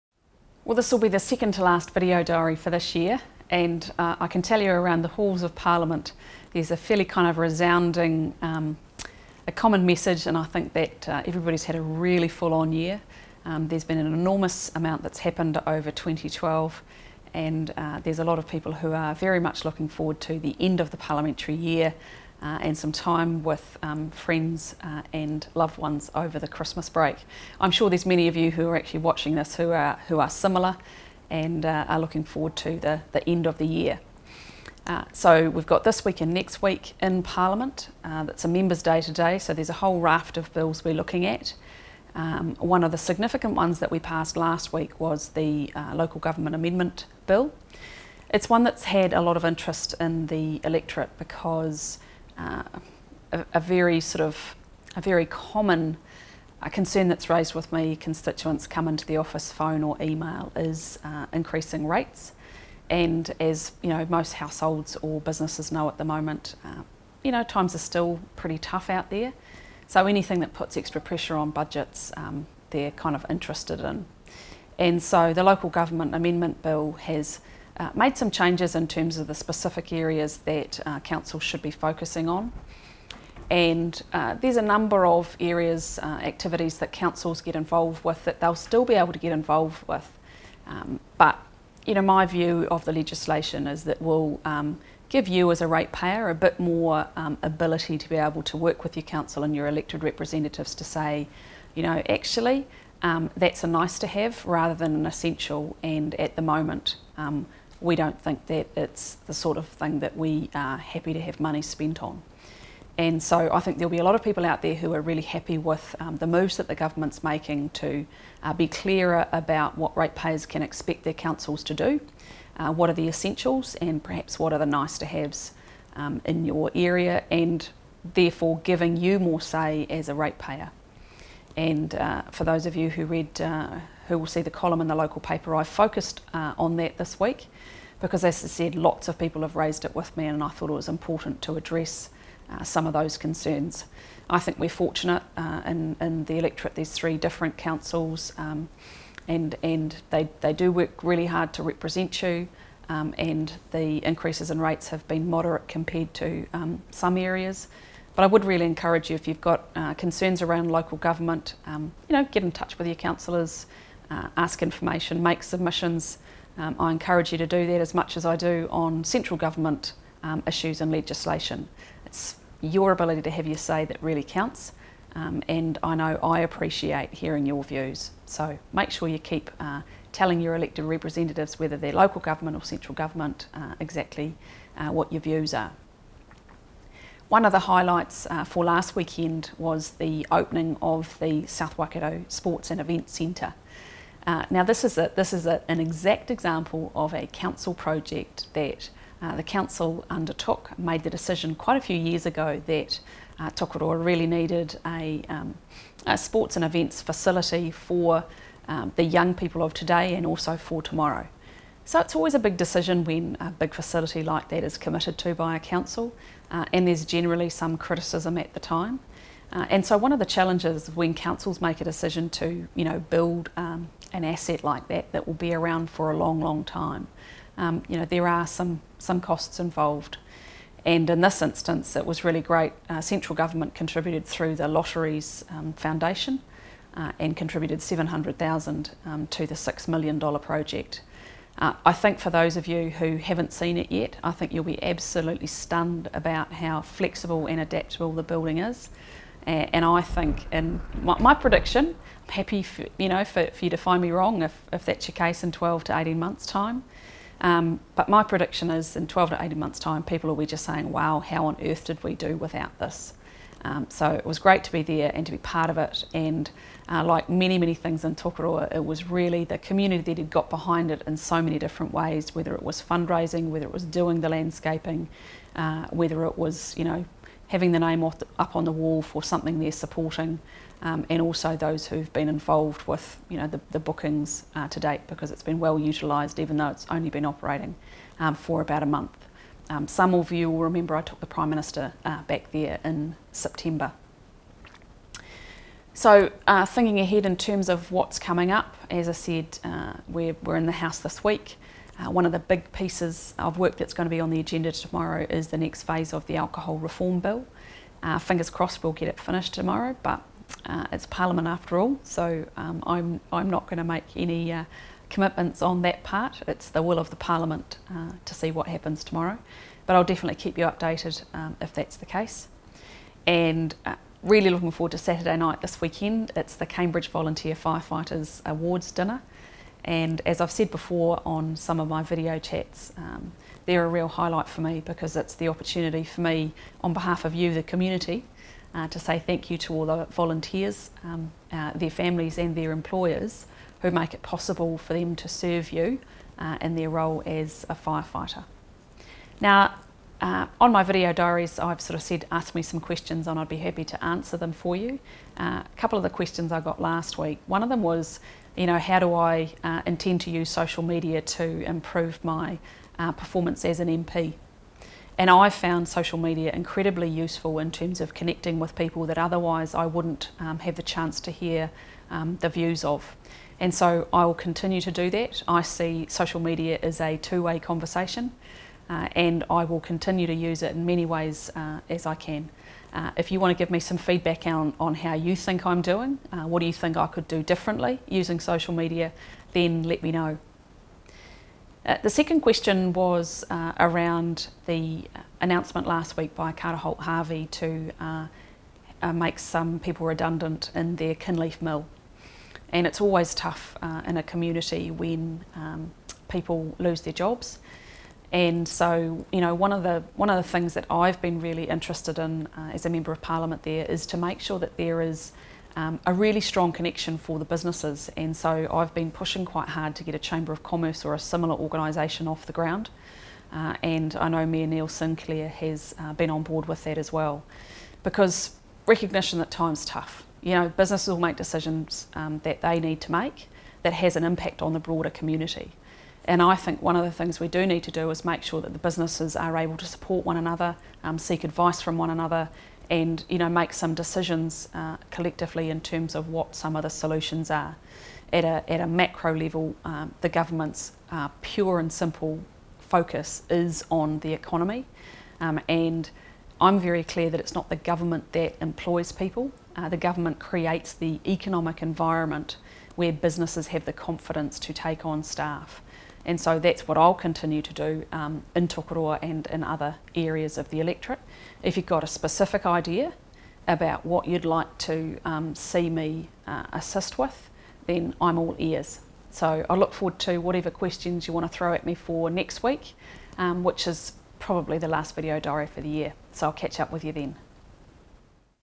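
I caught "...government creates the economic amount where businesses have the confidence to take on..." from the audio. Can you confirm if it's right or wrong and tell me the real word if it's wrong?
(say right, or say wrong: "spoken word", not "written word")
wrong: "environment", not "amount".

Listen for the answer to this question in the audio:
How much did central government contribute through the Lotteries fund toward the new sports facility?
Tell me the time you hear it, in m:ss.
3:57.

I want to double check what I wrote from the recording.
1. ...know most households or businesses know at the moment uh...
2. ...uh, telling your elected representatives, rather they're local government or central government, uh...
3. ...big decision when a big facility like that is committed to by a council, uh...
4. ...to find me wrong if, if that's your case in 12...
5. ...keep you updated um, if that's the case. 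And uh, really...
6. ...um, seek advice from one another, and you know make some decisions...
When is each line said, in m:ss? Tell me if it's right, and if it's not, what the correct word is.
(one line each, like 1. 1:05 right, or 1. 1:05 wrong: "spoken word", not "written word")
1. 1:03 right
2. 2:59 wrong: "whether", not "rather"
3. 3:32 right
4. 4:13 right
5. 5:20 right
6. 7:21 right.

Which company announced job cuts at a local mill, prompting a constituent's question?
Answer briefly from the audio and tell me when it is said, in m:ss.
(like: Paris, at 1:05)
Carter Holt Harvey, at 6:36.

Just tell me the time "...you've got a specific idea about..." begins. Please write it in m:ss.
7:51.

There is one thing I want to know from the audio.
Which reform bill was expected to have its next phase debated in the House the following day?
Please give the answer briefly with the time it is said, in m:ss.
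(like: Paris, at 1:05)
alcohol reform bill, at 5:06.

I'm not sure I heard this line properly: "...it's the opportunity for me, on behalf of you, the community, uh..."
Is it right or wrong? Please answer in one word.
right.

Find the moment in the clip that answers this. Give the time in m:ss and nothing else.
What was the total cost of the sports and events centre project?
3:59.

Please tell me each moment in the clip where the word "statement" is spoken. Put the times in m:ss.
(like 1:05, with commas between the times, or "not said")
not said.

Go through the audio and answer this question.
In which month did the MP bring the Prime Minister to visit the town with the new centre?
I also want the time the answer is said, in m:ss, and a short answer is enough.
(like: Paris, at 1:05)
September, at 4:53.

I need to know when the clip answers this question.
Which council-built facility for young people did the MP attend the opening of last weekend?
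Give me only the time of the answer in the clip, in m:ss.
3:11.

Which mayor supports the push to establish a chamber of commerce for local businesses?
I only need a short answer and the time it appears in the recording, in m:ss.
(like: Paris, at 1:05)
Neil Sinclair, at 7:04.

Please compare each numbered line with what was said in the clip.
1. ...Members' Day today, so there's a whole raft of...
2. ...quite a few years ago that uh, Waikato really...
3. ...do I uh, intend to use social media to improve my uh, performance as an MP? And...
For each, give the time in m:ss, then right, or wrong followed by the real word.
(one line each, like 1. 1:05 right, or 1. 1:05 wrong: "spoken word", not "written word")
1. 0:38 right
2. 3:21 wrong: "Tokoroa", not "Waikato"
3. 5:58 right.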